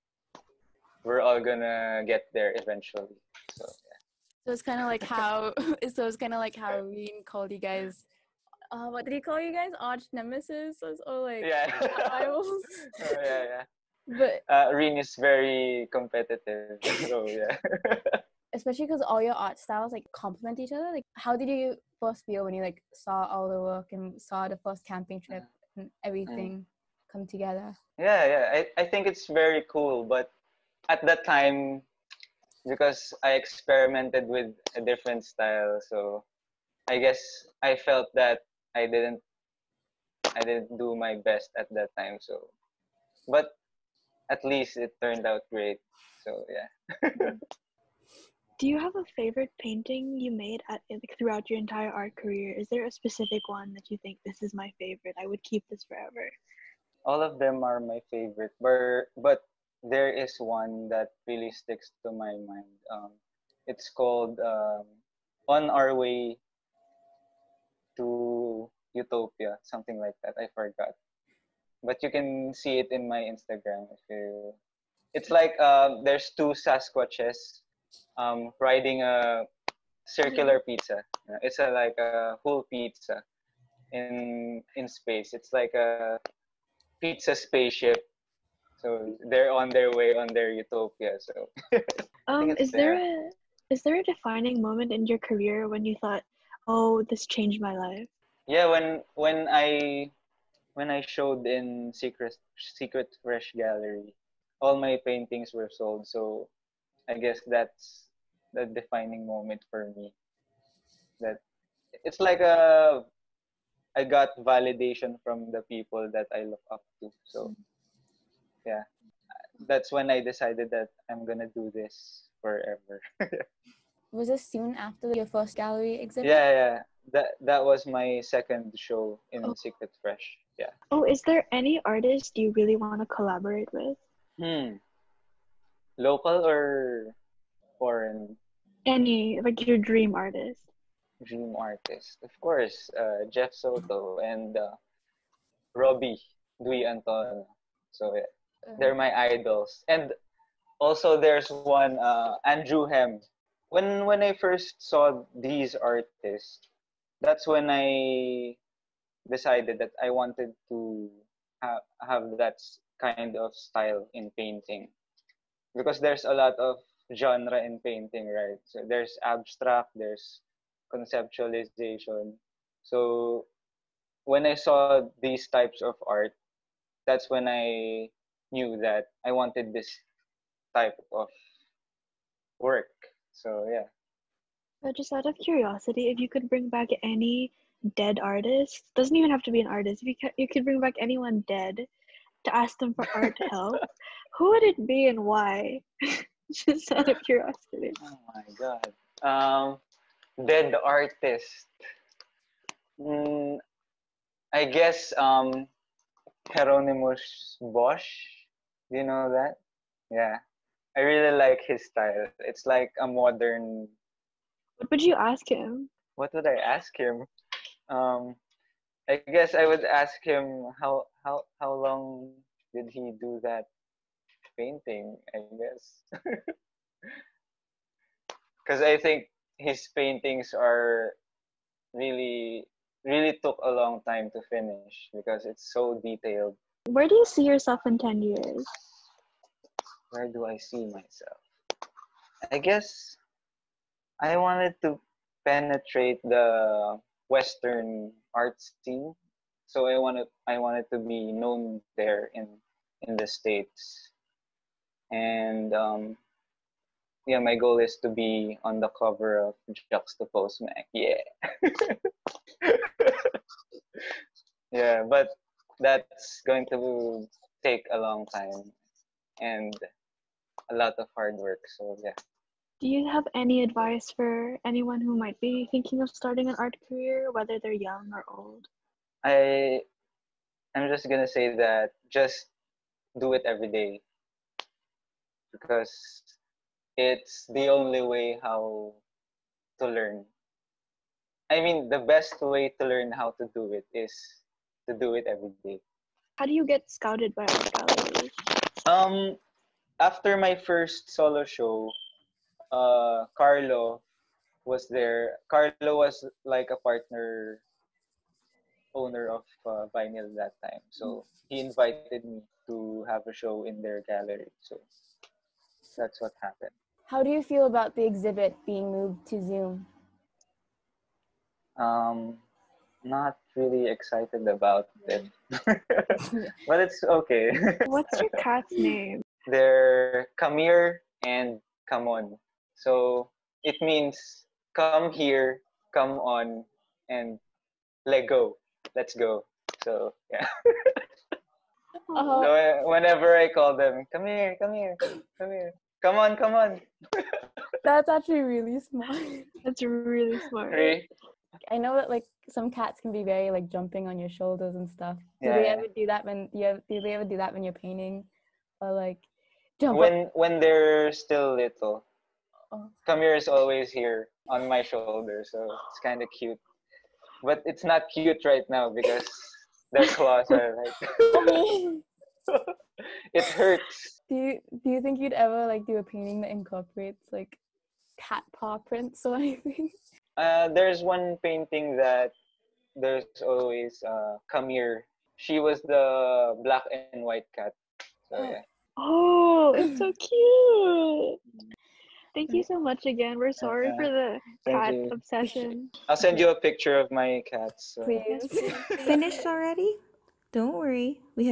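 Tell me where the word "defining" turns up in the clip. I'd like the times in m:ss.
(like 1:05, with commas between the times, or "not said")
1:34, 1:48.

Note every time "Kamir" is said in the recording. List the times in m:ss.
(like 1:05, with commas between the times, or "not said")
5:30, 6:03.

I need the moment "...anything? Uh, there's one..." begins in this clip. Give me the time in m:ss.
6:19.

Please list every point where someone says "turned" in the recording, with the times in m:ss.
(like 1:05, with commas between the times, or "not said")
0:45.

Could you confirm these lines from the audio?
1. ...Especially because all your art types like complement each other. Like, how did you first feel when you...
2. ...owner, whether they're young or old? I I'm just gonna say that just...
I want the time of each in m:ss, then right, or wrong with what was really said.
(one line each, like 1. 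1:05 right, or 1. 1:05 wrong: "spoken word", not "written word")
1. 0:18 wrong: "styles", not "types"
2. 4:36 wrong: "career", not "owner".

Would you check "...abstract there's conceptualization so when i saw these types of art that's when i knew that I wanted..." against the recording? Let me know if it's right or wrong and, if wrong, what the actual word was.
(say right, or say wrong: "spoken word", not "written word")
right.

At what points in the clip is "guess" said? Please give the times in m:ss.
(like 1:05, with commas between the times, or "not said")
0:36, 1:47, 3:24, 3:39, 3:45, 4:02.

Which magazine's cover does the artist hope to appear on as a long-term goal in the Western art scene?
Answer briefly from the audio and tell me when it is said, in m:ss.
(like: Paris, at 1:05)
Juxtapose, at 4:19.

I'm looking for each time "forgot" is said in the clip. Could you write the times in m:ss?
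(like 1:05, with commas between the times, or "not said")
1:10.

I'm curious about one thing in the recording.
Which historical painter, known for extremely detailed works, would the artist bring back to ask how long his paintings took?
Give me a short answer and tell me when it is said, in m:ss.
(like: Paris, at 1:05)
Hieronymus Bosch, at 3:26.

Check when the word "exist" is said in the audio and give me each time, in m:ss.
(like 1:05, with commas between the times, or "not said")
not said.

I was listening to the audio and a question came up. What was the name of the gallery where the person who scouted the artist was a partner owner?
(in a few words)
Vinyl.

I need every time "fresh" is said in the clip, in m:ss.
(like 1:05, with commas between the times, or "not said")
1:43, 2:10.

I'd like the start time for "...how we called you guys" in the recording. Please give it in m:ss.
0:06.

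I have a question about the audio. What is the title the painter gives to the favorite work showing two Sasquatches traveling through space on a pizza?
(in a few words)
On Our Way to Utopia.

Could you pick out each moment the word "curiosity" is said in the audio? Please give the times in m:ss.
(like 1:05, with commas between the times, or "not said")
3:05, 3:17.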